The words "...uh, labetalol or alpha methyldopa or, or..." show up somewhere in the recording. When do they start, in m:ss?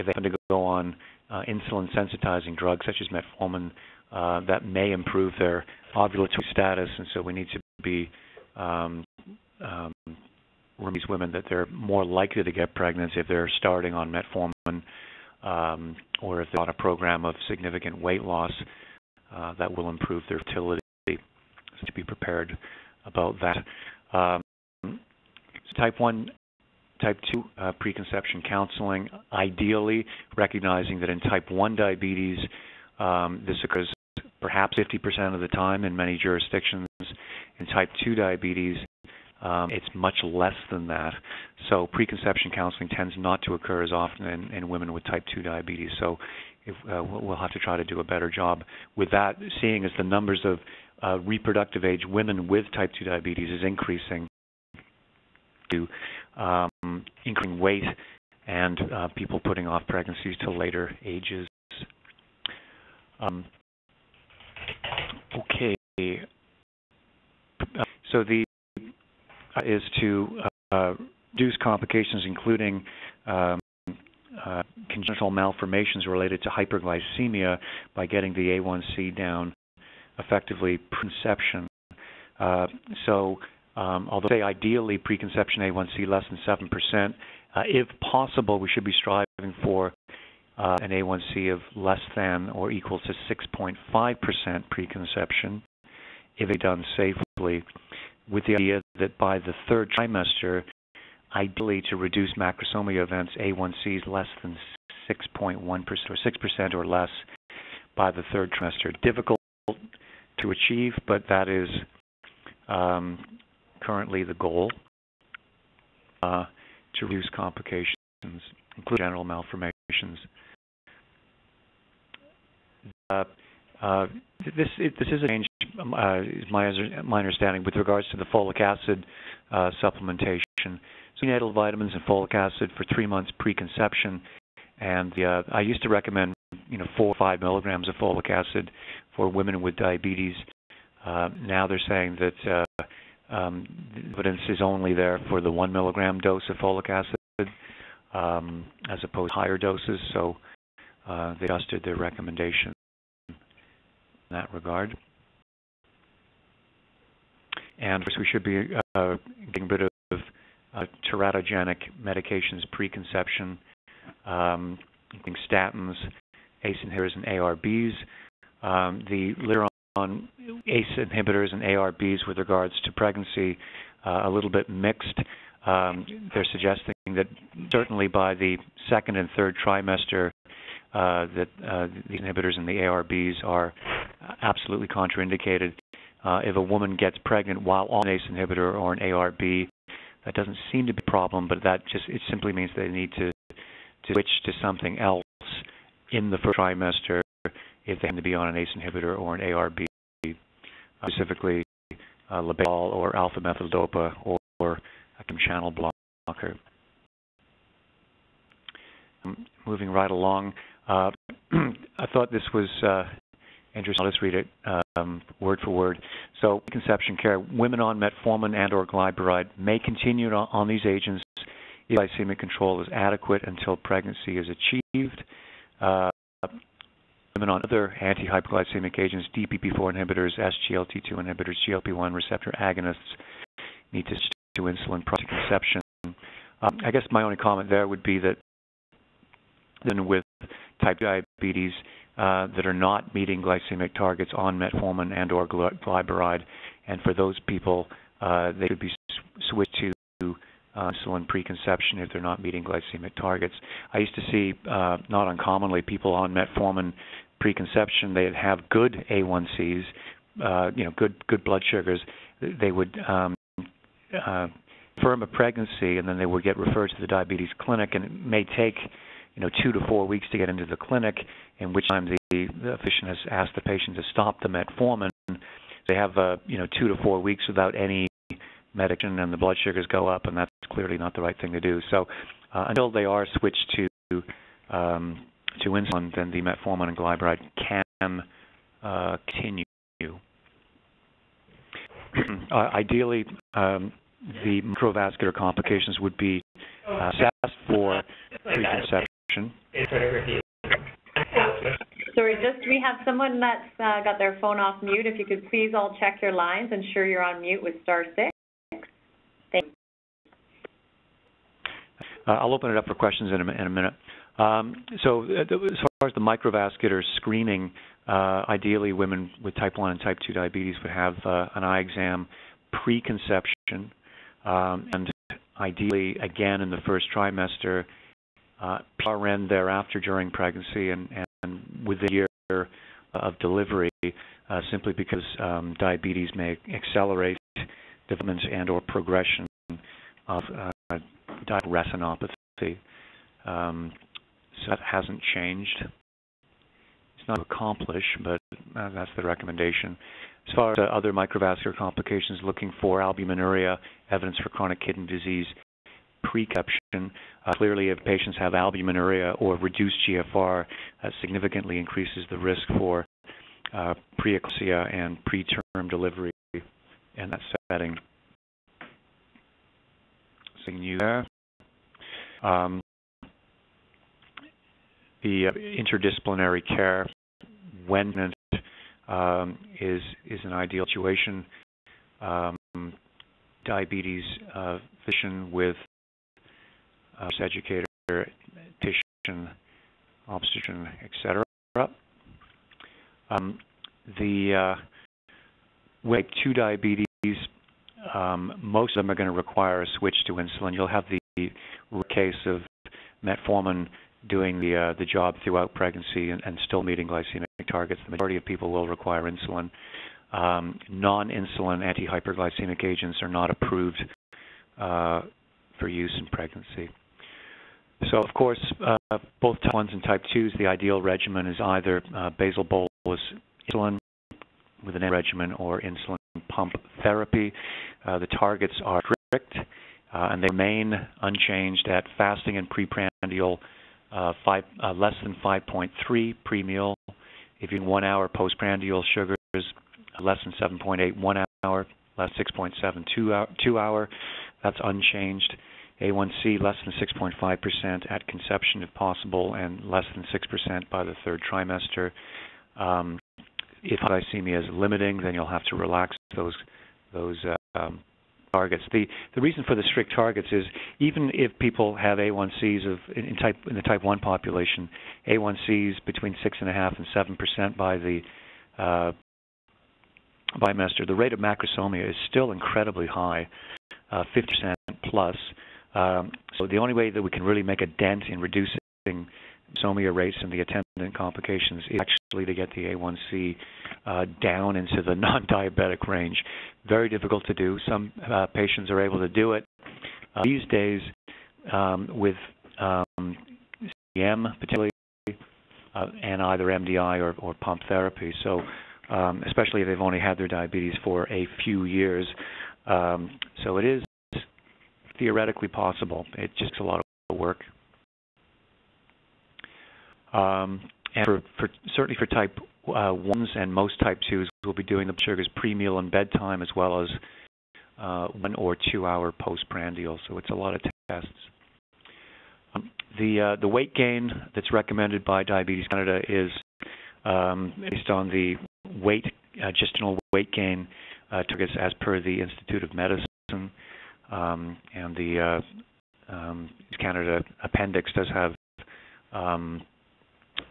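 3:22.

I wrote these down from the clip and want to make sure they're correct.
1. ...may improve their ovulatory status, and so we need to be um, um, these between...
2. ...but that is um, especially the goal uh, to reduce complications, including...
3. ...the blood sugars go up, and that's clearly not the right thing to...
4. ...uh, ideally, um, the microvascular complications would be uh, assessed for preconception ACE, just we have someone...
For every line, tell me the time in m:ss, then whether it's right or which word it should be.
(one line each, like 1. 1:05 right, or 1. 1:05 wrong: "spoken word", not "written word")
1. 0:04 wrong: "women", not "between"
2. 1:51 wrong: "currently", not "especially"
3. 4:39 right
4. 4:52 wrong: "Sorry", not "ACE".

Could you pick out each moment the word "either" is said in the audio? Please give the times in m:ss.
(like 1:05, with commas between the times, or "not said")
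7:01, 8:16.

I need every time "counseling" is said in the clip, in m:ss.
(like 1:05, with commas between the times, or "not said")
0:28, 0:42.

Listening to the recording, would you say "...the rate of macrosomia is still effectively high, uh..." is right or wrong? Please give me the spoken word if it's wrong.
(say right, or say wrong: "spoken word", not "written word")
wrong: "incredibly", not "effectively".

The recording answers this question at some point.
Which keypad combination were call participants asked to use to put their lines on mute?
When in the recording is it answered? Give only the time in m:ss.
5:07.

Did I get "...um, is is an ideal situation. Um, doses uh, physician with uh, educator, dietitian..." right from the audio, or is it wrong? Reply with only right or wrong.
wrong.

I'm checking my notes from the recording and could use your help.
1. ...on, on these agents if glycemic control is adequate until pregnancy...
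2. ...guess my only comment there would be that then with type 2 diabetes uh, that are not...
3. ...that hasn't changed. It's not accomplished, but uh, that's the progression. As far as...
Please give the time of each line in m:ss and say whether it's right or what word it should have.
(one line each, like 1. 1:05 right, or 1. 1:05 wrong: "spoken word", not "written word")
1. 3:40 right
2. 3:56 right
3. 5:44 wrong: "recommendation", not "progression".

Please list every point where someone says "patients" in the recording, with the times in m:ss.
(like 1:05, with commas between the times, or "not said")
4:33, 5:58, 8:08.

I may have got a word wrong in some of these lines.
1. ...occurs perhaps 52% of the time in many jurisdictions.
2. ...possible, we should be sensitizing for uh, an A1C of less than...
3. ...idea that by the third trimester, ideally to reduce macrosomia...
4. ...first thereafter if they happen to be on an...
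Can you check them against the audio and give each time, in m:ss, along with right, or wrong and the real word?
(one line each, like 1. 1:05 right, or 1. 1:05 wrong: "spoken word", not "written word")
1. 0:33 wrong: "50", not "52"
2. 1:28 wrong: "striving", not "sensitizing"
3. 1:38 right
4. 3:16 wrong: "trimester", not "thereafter".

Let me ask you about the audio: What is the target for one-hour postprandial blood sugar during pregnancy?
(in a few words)
less than 7.8.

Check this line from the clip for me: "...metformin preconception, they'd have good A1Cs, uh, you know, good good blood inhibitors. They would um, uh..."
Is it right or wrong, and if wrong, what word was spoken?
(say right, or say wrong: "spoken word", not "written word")
wrong: "sugars", not "inhibitors".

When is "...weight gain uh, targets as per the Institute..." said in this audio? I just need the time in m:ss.
8:50.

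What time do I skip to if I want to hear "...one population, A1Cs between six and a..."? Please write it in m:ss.
7:44.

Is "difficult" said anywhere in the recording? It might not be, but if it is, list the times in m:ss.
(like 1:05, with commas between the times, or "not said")
1:49, 8:07.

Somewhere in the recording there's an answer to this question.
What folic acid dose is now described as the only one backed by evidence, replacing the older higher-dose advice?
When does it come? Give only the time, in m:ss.
2:25.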